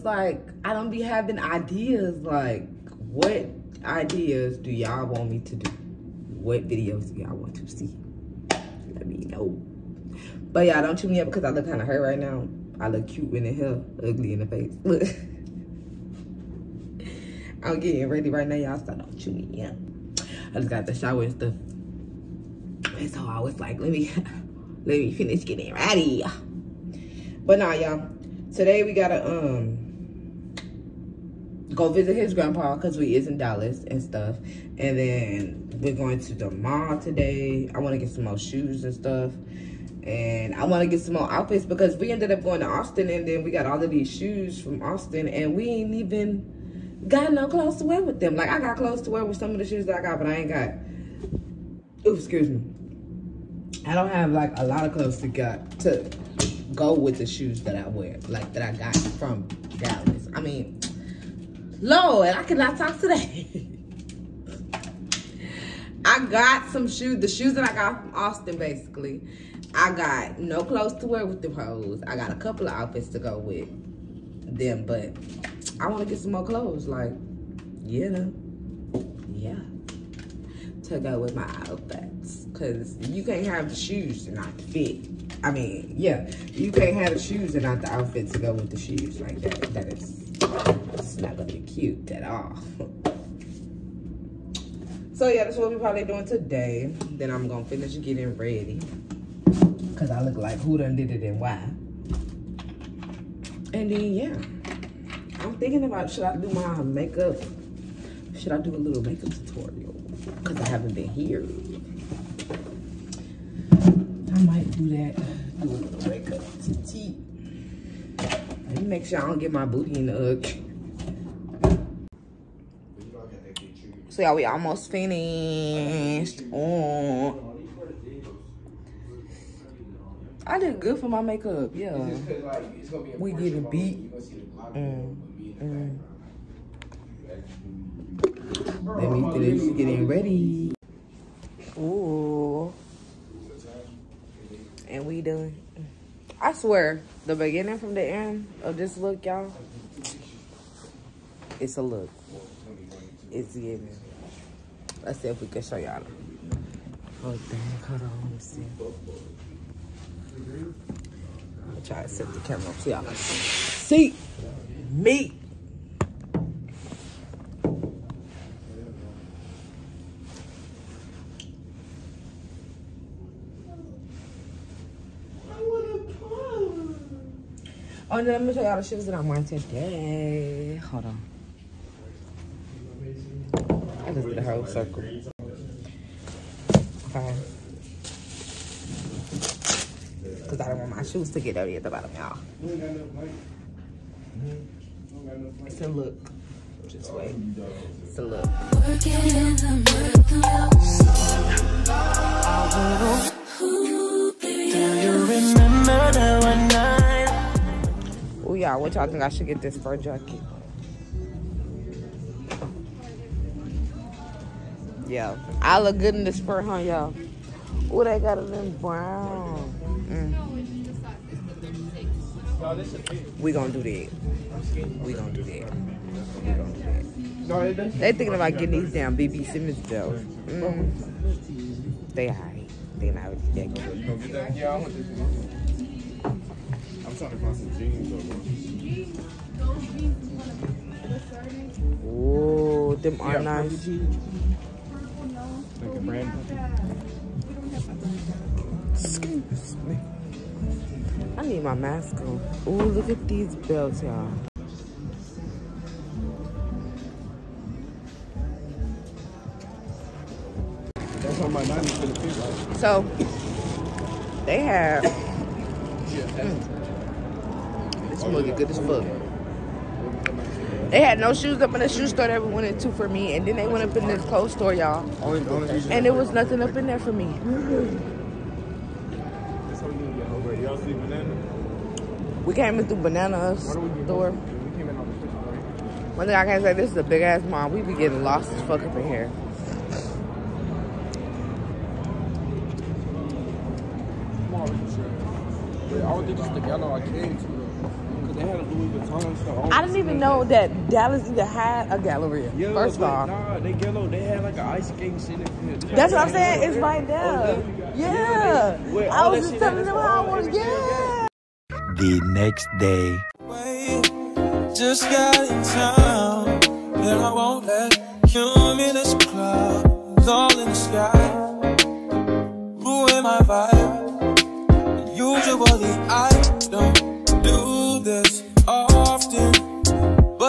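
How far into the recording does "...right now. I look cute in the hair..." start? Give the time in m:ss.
0:12.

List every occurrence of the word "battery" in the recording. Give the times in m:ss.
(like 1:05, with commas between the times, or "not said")
not said.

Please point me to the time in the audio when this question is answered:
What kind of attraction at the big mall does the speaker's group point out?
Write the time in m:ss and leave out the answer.
5:04.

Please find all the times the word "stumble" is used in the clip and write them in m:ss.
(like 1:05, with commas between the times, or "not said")
not said.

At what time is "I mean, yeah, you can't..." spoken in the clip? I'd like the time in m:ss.
1:25.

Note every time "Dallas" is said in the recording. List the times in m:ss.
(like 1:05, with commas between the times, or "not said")
0:33, 0:59, 5:00.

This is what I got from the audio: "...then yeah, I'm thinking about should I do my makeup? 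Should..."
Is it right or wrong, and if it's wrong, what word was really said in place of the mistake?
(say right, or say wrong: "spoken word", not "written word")
right.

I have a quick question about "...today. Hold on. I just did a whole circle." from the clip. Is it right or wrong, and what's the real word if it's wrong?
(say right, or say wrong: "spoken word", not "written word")
right.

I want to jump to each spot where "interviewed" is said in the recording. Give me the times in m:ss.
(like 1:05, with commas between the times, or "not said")
not said.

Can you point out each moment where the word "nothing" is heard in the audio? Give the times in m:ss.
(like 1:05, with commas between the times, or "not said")
4:36.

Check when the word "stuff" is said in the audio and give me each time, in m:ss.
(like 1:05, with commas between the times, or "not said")
0:21, 0:34, 0:38.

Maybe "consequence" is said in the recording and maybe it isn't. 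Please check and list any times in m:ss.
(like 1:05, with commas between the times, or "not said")
not said.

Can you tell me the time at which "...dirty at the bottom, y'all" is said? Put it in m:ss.
3:11.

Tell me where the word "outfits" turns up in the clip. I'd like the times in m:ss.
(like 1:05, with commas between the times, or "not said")
0:41, 1:12, 1:21, 1:27.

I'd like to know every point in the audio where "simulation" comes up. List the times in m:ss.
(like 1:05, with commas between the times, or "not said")
not said.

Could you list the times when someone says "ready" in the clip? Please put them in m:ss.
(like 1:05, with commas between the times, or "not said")
0:18, 0:25, 1:38, 2:20.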